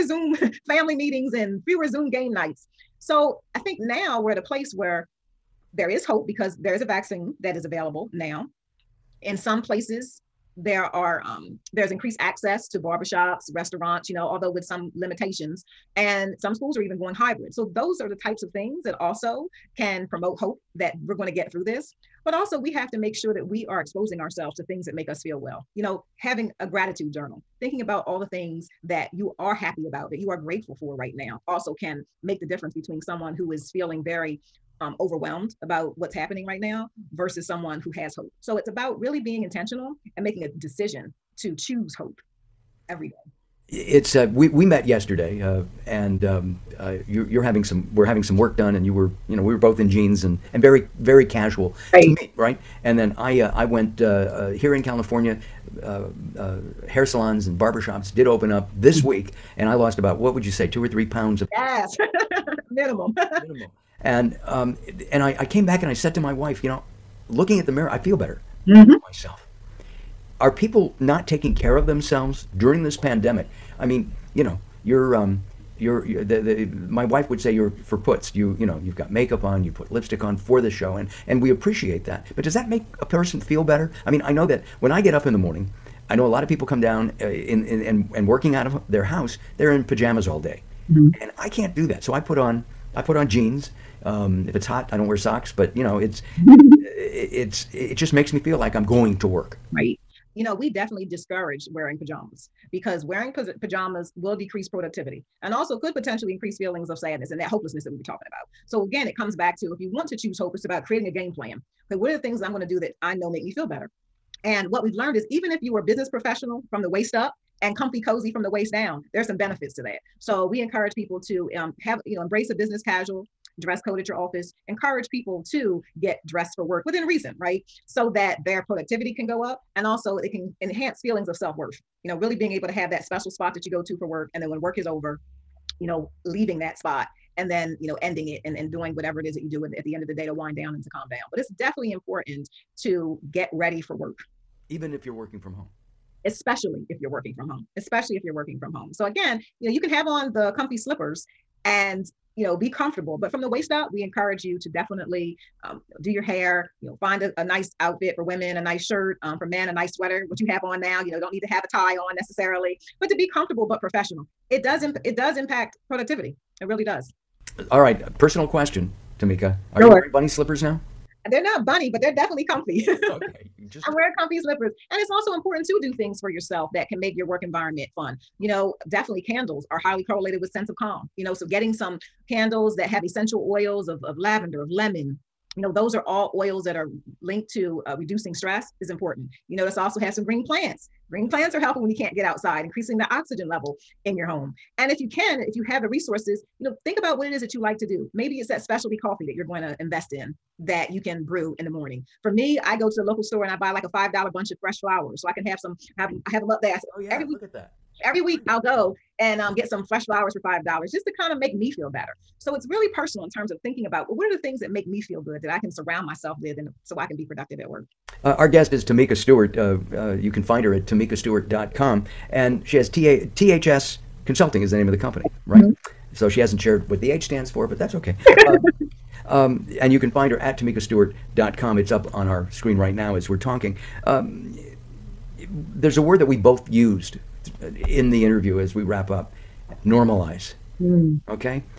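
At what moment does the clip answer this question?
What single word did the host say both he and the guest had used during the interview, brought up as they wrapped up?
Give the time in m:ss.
3:59.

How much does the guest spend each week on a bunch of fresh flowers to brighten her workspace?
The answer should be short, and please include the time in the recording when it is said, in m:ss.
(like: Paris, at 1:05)
$5, at 3:23.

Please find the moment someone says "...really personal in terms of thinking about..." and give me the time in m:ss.
3:32.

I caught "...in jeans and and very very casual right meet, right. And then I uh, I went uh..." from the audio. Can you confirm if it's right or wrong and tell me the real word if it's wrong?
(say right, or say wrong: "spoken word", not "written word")
right.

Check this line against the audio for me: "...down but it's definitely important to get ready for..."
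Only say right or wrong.
right.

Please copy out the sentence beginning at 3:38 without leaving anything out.
Uh, our guest is Tamika Stewart.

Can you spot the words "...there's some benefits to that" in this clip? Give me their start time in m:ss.
1:59.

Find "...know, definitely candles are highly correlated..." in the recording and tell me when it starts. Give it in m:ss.
2:58.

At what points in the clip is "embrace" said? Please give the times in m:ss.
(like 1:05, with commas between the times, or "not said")
2:02.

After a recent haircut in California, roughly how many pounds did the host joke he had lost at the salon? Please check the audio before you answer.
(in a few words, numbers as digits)
2 or 3.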